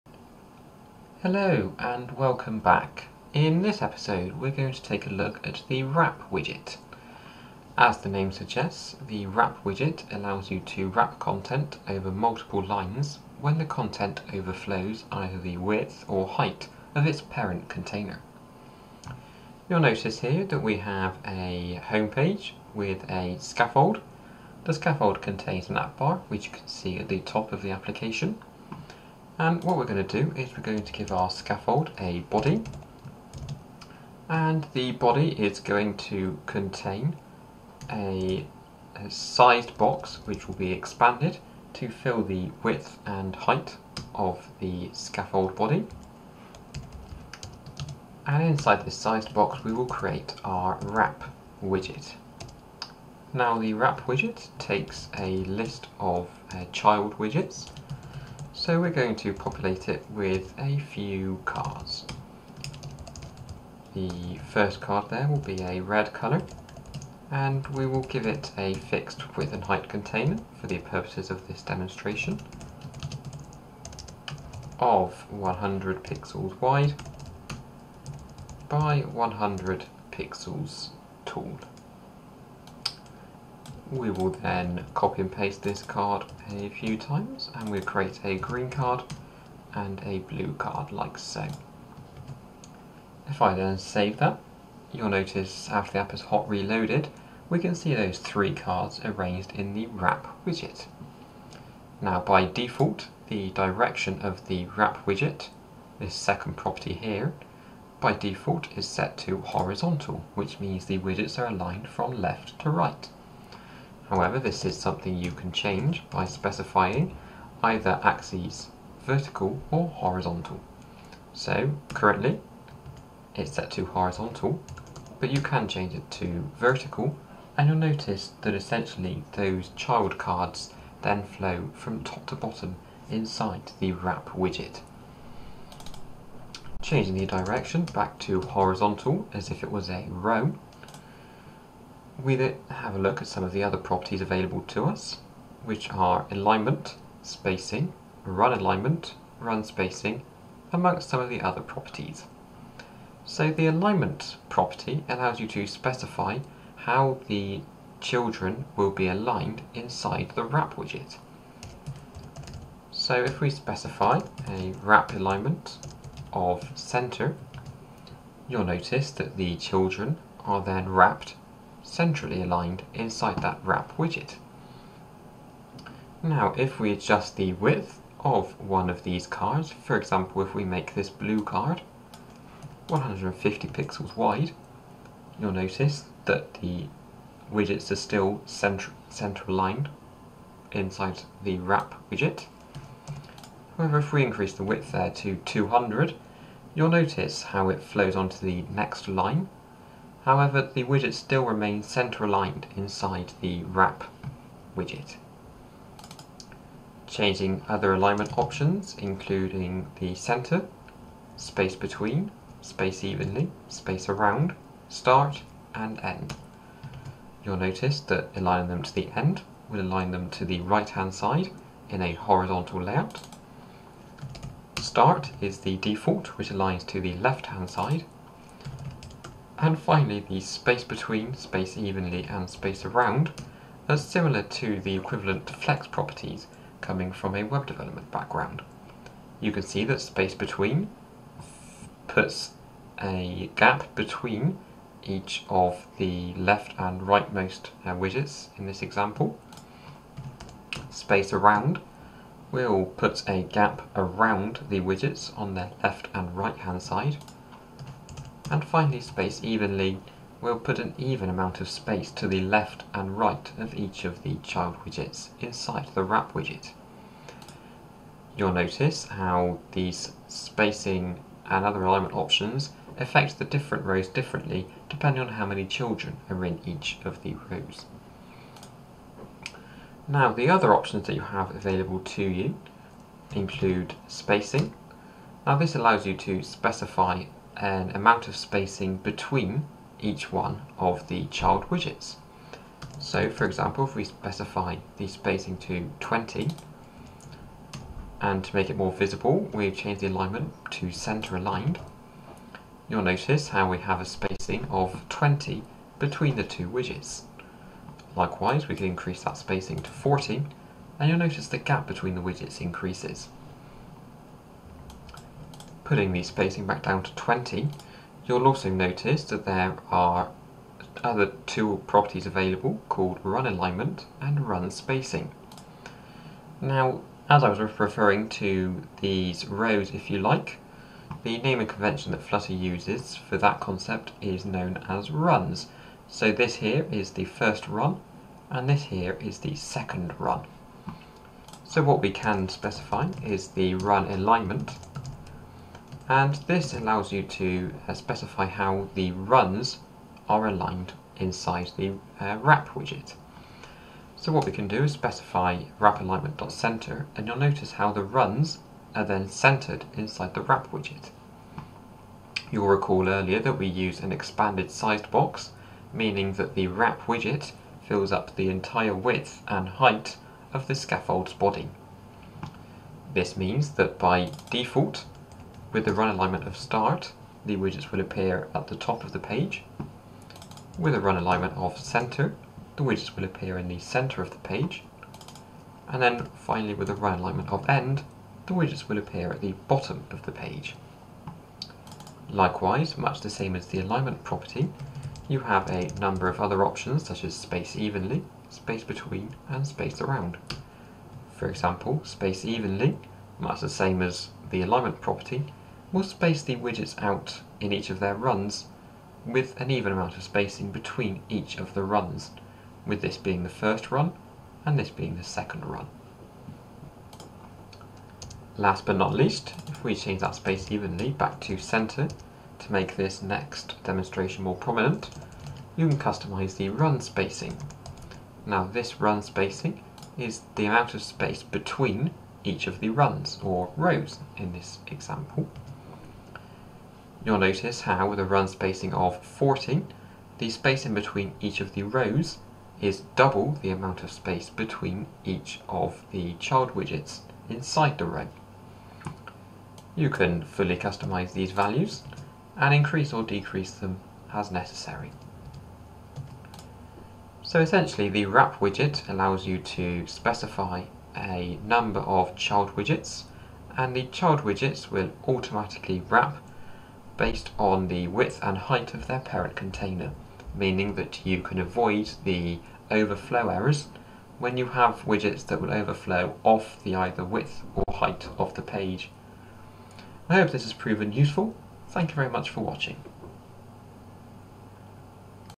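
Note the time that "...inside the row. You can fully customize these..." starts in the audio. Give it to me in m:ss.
7:27.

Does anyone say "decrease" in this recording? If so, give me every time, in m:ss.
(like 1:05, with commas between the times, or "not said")
7:33.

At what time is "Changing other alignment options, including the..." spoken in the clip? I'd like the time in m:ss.
3:27.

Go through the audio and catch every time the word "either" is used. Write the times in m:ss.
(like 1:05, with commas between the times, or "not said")
0:15, 1:57, 7:56.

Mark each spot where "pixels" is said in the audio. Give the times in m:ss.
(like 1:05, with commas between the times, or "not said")
1:16, 1:20, 3:03.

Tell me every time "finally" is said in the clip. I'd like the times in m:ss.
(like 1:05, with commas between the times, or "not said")
3:49, 4:18, 6:26.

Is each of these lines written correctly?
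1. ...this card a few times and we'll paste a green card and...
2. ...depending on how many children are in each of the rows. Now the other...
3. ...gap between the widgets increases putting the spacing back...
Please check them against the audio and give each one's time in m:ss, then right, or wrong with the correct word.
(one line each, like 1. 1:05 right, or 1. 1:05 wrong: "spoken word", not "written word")
1. 1:25 wrong: "create", not "paste"
2. 4:34 right
3. 5:11 right.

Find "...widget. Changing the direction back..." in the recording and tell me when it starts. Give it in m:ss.
2:14.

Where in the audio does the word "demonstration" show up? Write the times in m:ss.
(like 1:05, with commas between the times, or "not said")
1:11, 7:03.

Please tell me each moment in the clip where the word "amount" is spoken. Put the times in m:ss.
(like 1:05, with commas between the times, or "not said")
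4:21, 4:47, 6:49, 7:10, 7:23.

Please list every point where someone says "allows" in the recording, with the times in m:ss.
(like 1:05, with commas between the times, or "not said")
0:10, 2:35, 4:45, 5:46, 7:39.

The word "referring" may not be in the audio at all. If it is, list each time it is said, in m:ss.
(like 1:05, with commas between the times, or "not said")
5:27.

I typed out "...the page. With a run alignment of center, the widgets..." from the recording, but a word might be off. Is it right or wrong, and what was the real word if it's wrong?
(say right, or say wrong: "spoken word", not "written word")
right.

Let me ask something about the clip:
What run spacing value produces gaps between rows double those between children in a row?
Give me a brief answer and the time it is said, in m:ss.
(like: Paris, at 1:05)
14, at 7:19.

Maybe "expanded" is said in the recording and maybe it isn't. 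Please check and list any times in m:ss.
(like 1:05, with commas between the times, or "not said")
0:40, 6:04.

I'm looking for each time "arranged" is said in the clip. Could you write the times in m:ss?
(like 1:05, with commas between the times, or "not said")
1:39.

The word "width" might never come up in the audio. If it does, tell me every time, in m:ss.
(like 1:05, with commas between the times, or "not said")
0:15, 0:42, 1:09, 2:57, 3:14, 6:08, 7:48, 7:57.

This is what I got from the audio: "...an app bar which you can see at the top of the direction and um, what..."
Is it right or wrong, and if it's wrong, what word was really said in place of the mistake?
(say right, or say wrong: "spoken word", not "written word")
wrong: "application", not "direction".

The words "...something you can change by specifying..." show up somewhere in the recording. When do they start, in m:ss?
1:54.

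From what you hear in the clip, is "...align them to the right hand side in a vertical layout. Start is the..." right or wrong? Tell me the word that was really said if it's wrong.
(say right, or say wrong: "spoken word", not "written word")
wrong: "horizontal", not "vertical".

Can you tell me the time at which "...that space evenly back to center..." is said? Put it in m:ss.
7:00.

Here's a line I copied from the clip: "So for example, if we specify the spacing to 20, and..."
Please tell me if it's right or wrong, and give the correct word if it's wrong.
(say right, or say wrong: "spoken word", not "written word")
right.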